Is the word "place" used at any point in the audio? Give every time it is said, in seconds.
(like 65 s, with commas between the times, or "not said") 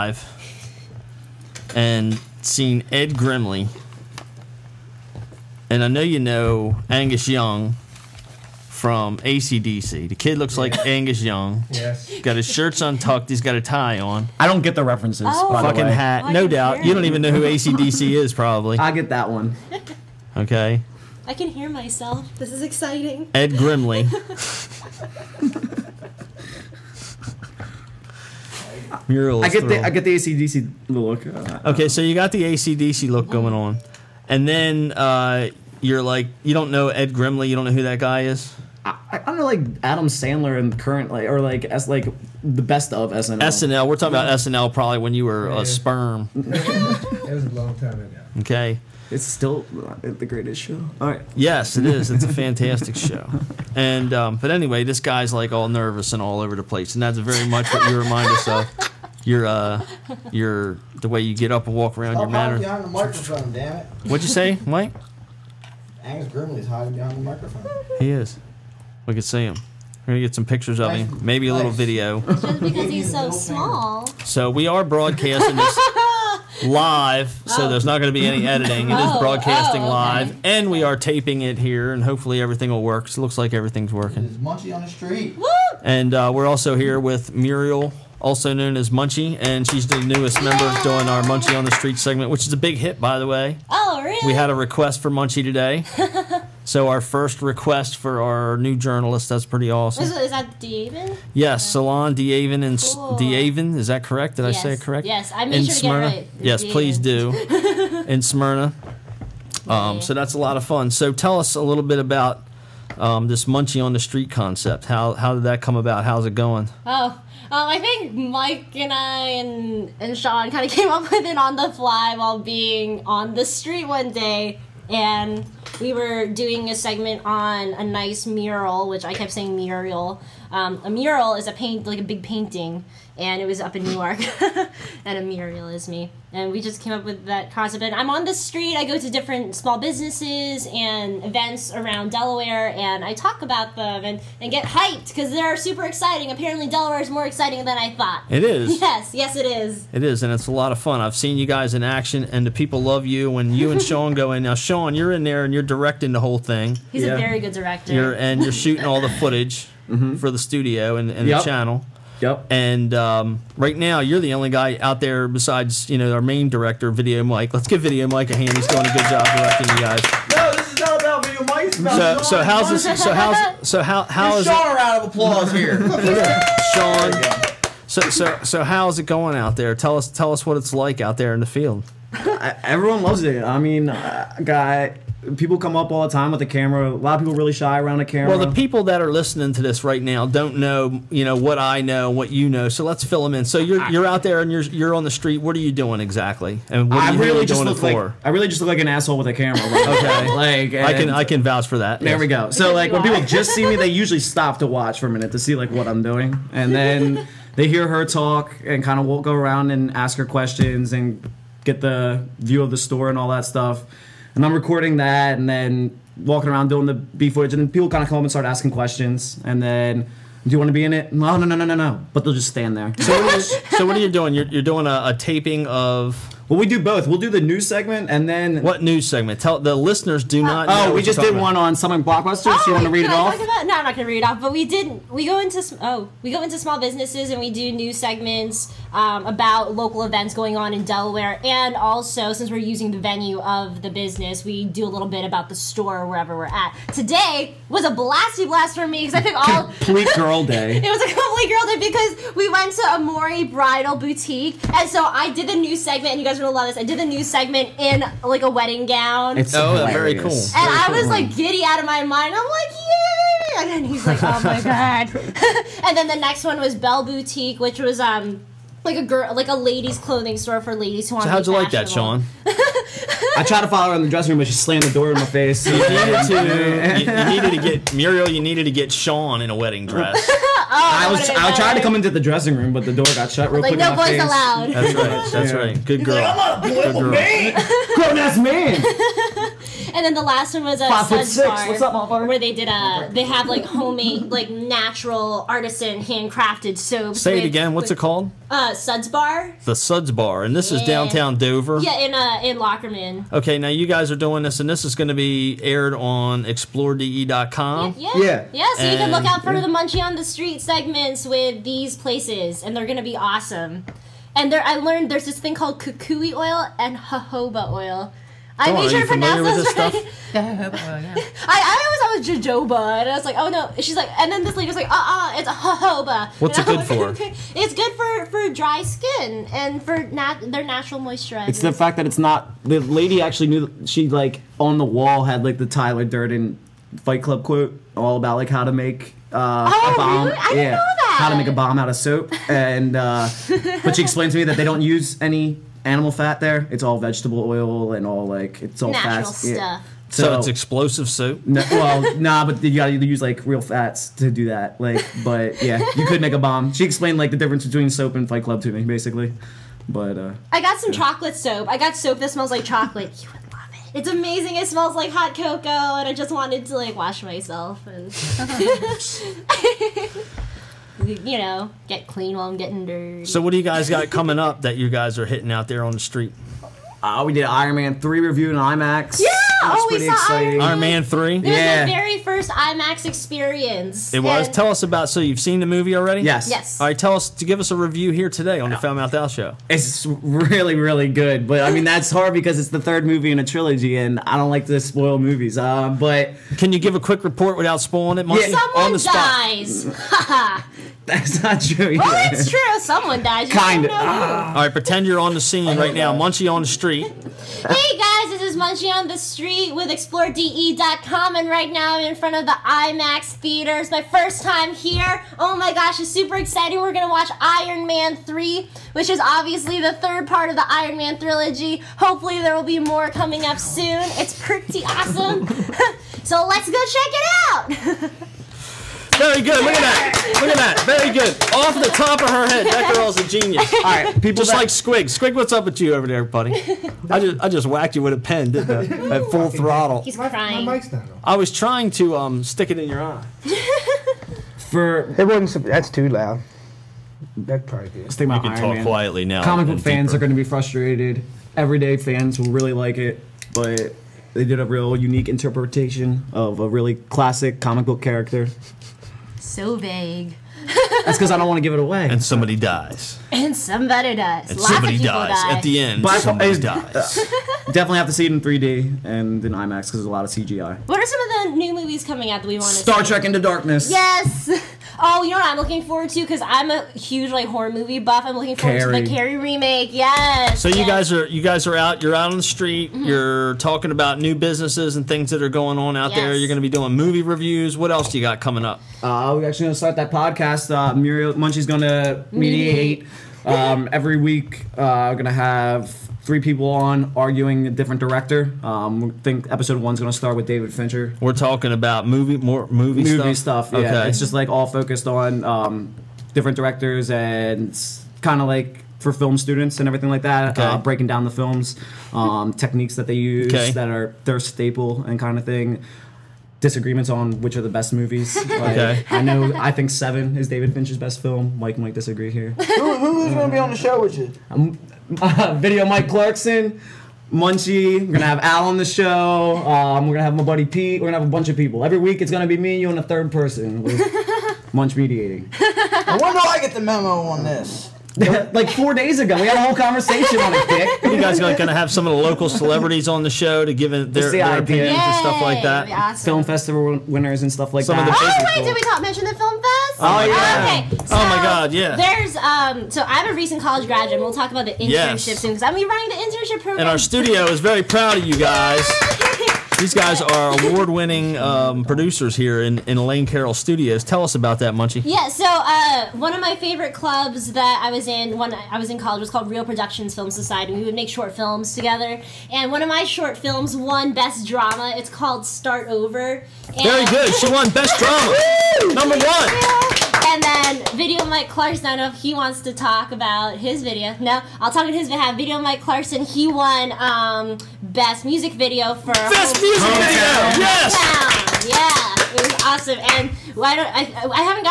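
56 s, 311 s.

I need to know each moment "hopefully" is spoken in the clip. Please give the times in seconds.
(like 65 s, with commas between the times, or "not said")
82 s, 421 s.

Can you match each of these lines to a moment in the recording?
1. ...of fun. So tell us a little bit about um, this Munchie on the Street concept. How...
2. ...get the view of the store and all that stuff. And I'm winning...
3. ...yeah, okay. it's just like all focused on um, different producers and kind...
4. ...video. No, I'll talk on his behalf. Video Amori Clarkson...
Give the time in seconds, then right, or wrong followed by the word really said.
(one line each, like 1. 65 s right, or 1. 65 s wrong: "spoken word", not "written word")
1. 110 s right
2. 211 s wrong: "recording", not "winning"
3. 503 s wrong: "directors", not "producers"
4. 583 s wrong: "Mike", not "Amori".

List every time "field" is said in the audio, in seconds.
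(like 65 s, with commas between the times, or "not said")
181 s.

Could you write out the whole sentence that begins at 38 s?
I, I don't know, like Adam Sandler and currently, like or like as like the best of SNL.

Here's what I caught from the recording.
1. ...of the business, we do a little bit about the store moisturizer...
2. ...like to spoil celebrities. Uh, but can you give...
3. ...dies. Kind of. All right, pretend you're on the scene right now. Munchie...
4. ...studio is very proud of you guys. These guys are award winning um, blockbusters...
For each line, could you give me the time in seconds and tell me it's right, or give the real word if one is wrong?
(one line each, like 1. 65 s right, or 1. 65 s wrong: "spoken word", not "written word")
1. 243 s wrong: "wherever", not "moisturizer"
2. 394 s wrong: "movies", not "celebrities"
3. 403 s right
4. 556 s wrong: "producers", not "blockbusters".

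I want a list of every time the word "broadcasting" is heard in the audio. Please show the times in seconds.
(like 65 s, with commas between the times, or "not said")
74 s, 79 s.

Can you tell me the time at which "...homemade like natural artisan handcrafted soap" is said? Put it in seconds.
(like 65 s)
293 s.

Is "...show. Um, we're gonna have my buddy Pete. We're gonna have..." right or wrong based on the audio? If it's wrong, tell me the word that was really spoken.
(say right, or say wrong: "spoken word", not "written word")
right.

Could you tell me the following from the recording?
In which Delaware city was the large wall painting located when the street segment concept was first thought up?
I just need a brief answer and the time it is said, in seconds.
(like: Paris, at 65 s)
Newark, at 133 s.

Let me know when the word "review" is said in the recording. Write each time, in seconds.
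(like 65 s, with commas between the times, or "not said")
378 s, 387 s, 487 s.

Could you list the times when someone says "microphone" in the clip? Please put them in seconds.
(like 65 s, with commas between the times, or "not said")
62 s, 67 s.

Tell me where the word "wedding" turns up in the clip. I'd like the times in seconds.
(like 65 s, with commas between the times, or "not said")
258 s, 279 s.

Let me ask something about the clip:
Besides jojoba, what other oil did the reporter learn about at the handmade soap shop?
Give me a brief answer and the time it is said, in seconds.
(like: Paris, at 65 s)
kukui oil, at 315 s.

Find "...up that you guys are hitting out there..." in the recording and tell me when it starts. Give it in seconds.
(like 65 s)
374 s.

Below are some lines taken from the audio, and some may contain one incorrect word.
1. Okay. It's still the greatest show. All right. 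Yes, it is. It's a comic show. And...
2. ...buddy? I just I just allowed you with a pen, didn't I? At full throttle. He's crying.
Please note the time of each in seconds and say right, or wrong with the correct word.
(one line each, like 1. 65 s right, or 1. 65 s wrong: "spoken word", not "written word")
1. 48 s wrong: "fantastic", not "comic"
2. 436 s wrong: "whacked", not "allowed".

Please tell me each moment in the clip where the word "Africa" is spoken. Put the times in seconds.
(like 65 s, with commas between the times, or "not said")
not said.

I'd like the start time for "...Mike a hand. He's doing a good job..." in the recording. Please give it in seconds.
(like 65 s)
168 s.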